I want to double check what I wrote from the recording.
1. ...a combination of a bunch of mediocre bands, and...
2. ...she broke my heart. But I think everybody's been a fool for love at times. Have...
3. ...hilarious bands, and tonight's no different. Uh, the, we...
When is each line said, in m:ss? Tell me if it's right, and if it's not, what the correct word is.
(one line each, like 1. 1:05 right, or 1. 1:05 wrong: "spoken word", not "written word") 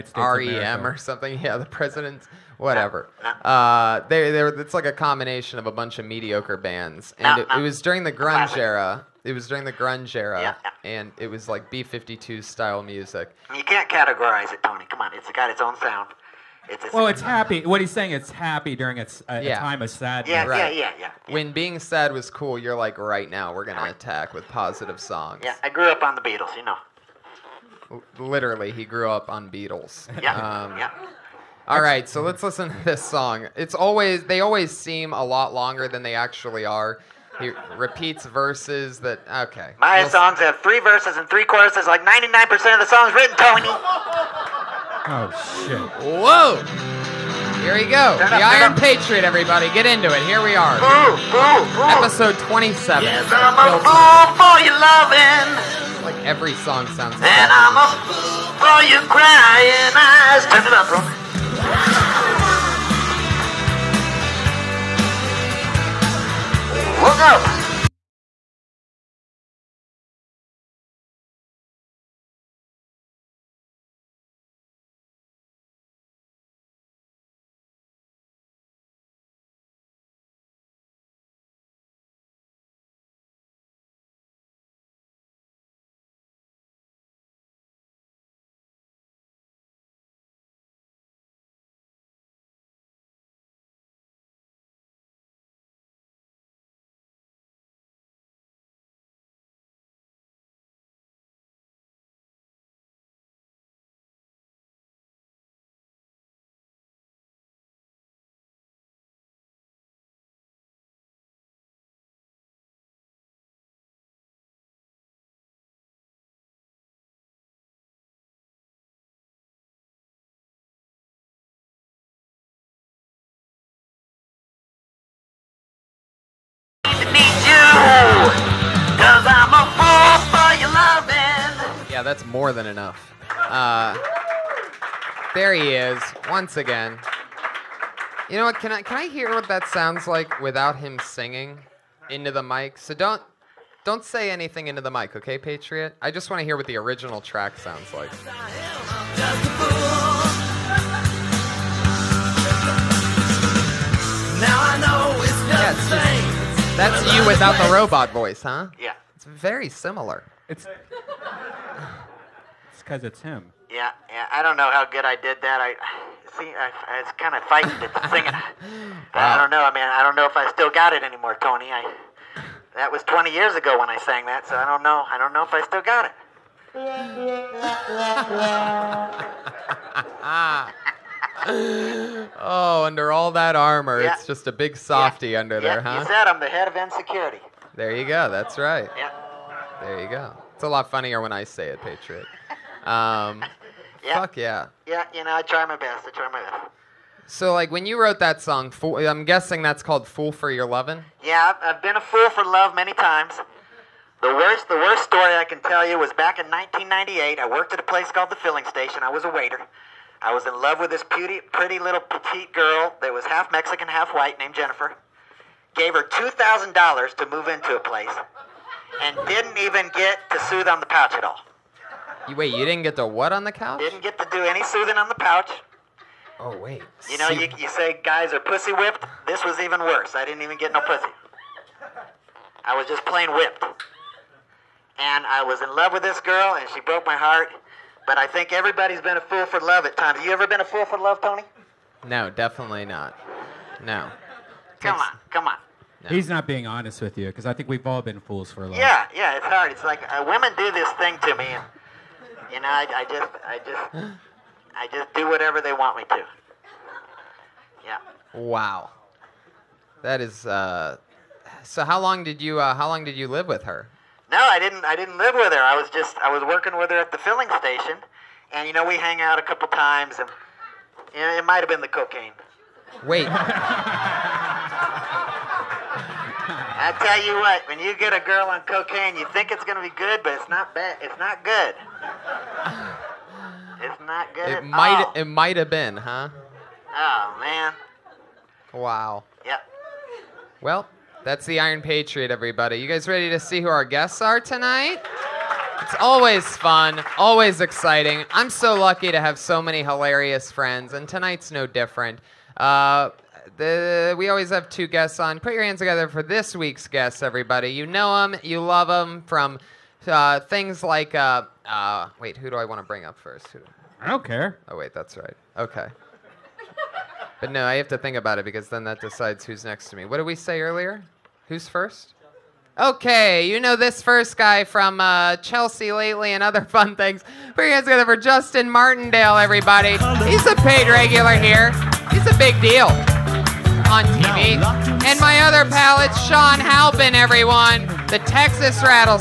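1. 0:04 right
2. 3:56 right
3. 4:59 wrong: "friends", not "bands".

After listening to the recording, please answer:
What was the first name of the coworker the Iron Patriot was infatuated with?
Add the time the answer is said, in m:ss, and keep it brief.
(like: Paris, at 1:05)
Jennifer, at 3:34.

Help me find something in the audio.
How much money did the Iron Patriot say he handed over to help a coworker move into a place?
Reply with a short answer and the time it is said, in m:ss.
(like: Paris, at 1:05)
$2,000, at 3:36.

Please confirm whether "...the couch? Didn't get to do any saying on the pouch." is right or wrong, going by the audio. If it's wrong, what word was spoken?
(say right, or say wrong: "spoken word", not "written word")
wrong: "soothing", not "saying".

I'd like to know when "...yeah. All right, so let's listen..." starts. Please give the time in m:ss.
0:30.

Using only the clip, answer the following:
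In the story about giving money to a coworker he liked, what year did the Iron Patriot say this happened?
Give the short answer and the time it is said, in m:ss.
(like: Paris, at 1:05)
1998, at 3:26.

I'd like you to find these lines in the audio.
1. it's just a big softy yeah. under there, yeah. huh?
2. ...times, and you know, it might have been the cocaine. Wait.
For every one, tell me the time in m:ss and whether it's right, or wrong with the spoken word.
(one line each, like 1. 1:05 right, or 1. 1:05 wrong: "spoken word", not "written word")
1. 3:04 right
2. 4:29 right.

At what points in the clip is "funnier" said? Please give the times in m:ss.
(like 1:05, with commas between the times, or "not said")
3:10.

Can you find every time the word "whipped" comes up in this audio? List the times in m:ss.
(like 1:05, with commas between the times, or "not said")
3:48, 3:53.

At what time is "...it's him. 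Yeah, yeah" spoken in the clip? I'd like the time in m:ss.
2:43.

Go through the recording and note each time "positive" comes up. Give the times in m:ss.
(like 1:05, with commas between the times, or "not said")
0:24.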